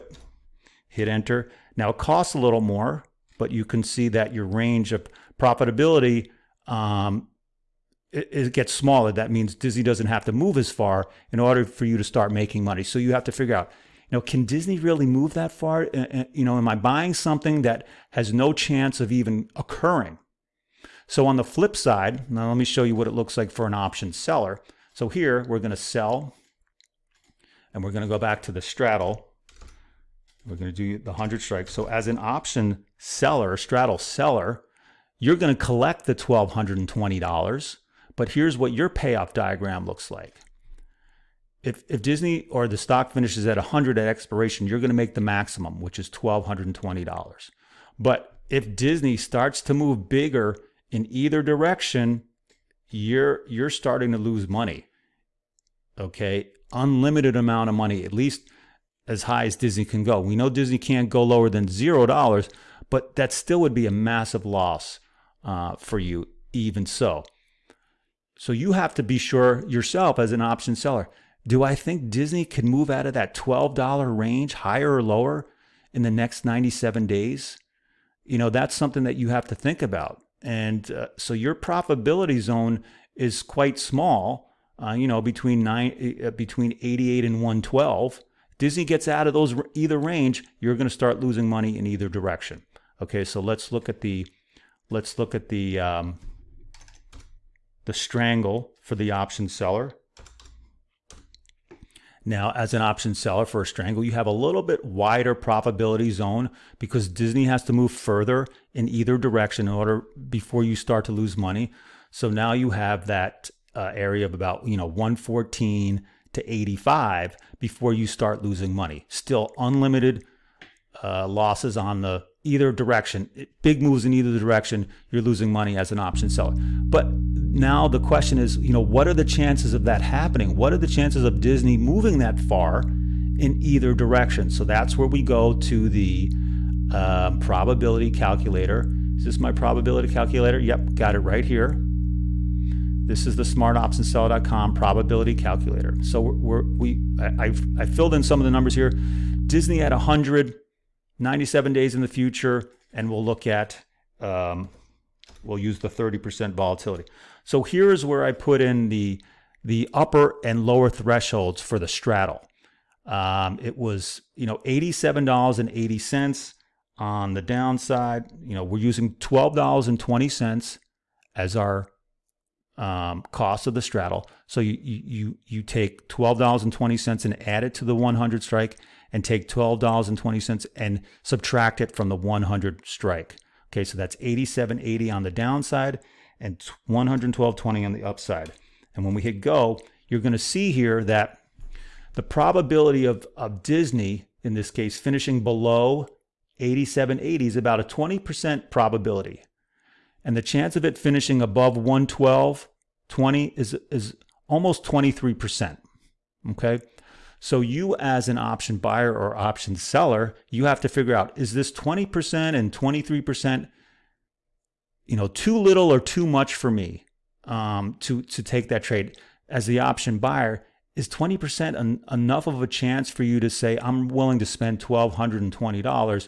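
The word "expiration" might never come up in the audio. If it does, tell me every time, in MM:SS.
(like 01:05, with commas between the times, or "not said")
00:44.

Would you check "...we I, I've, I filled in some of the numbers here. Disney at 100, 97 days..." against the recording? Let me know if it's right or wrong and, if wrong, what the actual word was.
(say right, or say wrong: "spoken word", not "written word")
right.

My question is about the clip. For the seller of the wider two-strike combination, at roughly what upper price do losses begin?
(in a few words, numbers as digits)
114.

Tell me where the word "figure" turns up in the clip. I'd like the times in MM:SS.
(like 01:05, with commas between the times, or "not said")
00:13, 03:30.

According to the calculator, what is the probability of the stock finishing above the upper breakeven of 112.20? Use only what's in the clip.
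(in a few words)
almost 23%.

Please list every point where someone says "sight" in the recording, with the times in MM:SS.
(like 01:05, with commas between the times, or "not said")
not said.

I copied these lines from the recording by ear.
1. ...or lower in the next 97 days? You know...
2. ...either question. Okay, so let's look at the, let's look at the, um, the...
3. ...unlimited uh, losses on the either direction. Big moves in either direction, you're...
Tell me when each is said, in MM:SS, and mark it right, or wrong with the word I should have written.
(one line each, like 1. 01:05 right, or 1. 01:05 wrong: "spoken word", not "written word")
1. 01:14 right
2. 01:31 wrong: "direction", not "question"
3. 01:59 right.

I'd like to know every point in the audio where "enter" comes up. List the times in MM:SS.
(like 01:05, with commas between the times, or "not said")
00:01.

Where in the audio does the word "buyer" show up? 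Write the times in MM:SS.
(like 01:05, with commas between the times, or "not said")
03:28, 03:40.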